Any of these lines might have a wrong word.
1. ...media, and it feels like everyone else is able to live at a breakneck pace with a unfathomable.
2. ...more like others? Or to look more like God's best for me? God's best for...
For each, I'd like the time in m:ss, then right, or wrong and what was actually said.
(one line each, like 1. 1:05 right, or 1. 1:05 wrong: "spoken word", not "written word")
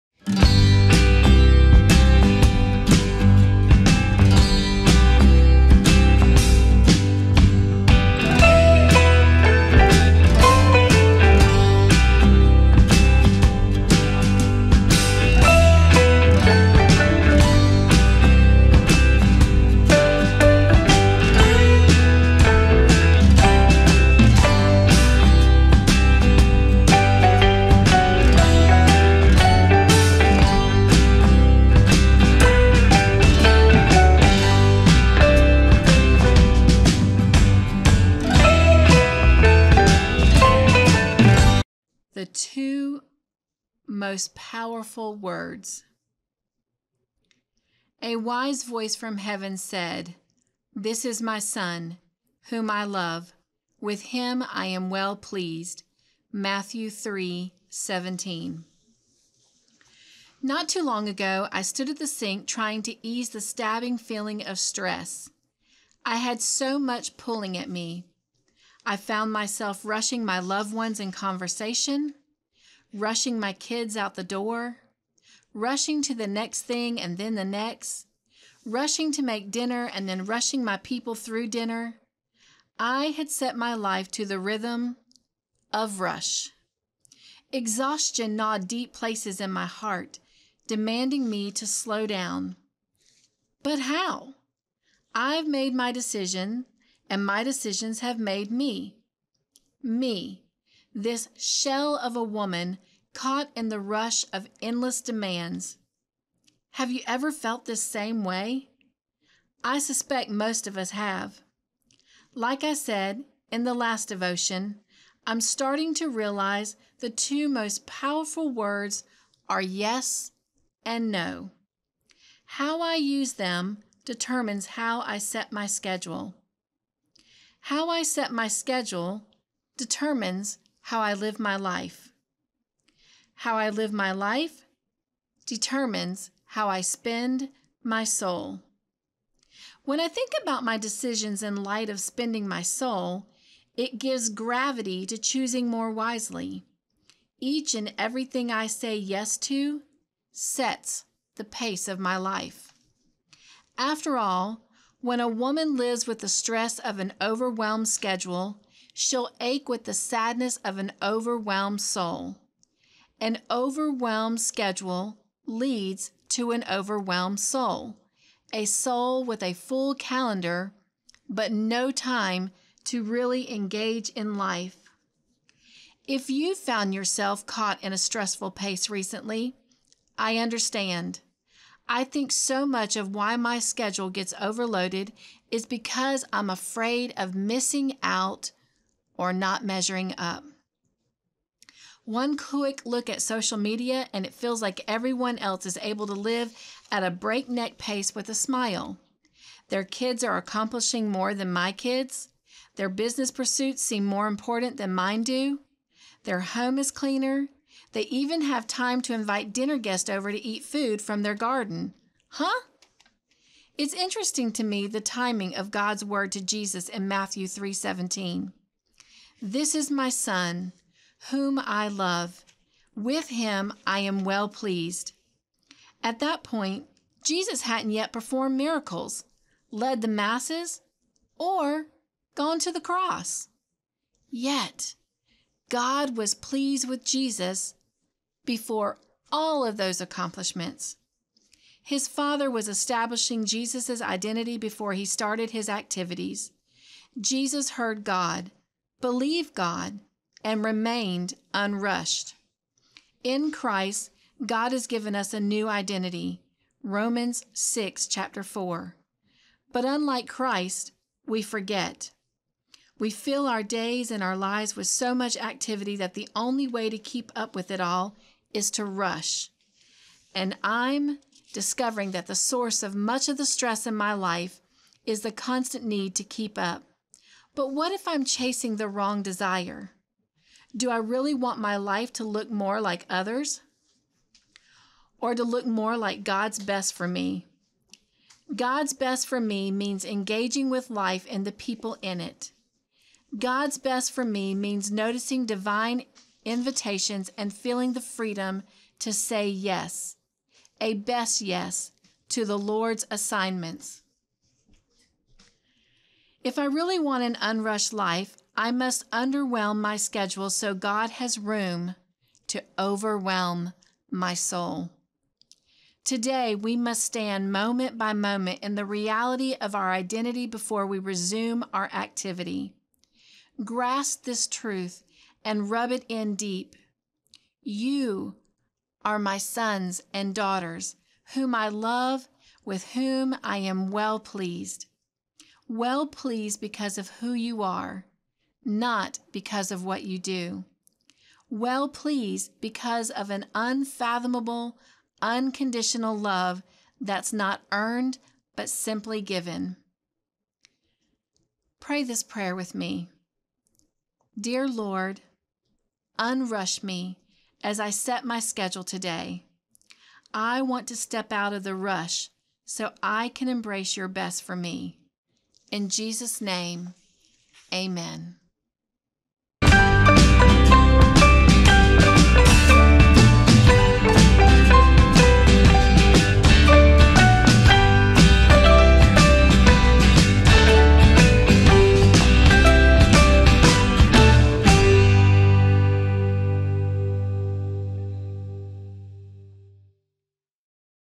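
1. 3:13 wrong: "smile", not "unfathomable"
2. 4:42 right.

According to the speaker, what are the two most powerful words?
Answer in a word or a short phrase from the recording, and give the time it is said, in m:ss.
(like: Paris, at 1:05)
Yes and no, at 1:59.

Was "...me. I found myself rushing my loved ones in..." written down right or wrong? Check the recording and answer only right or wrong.
right.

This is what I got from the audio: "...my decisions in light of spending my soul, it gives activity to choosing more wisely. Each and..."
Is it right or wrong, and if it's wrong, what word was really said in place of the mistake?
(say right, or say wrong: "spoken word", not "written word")
wrong: "gravity", not "activity".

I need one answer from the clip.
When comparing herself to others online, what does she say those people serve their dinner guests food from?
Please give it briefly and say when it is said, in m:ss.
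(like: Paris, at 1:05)
Their garden, at 3:31.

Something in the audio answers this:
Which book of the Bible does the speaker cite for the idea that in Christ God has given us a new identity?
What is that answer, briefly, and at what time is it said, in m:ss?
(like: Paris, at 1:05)
Romans, at 4:16.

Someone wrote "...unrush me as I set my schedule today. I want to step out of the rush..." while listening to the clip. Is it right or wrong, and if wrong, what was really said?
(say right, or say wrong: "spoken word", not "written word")
right.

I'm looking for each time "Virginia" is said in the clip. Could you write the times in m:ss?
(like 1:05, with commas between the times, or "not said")
not said.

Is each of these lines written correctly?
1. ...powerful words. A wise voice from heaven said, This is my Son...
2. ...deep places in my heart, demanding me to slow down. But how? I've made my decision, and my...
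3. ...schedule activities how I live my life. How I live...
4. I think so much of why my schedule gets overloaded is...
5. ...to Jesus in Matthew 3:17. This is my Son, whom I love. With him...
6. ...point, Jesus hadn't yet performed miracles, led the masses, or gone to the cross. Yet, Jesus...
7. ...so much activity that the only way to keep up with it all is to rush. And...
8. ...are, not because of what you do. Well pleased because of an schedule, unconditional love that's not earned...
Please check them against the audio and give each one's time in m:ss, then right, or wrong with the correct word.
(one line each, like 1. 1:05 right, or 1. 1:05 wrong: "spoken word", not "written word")
1. 0:44 right
2. 1:28 right
3. 2:08 wrong: "determines", not "activities"
4. 3:01 right
5. 3:36 right
6. 3:46 wrong: "God", not "Jesus"
7. 4:24 right
8. 5:37 wrong: "unfathomable", not "schedule".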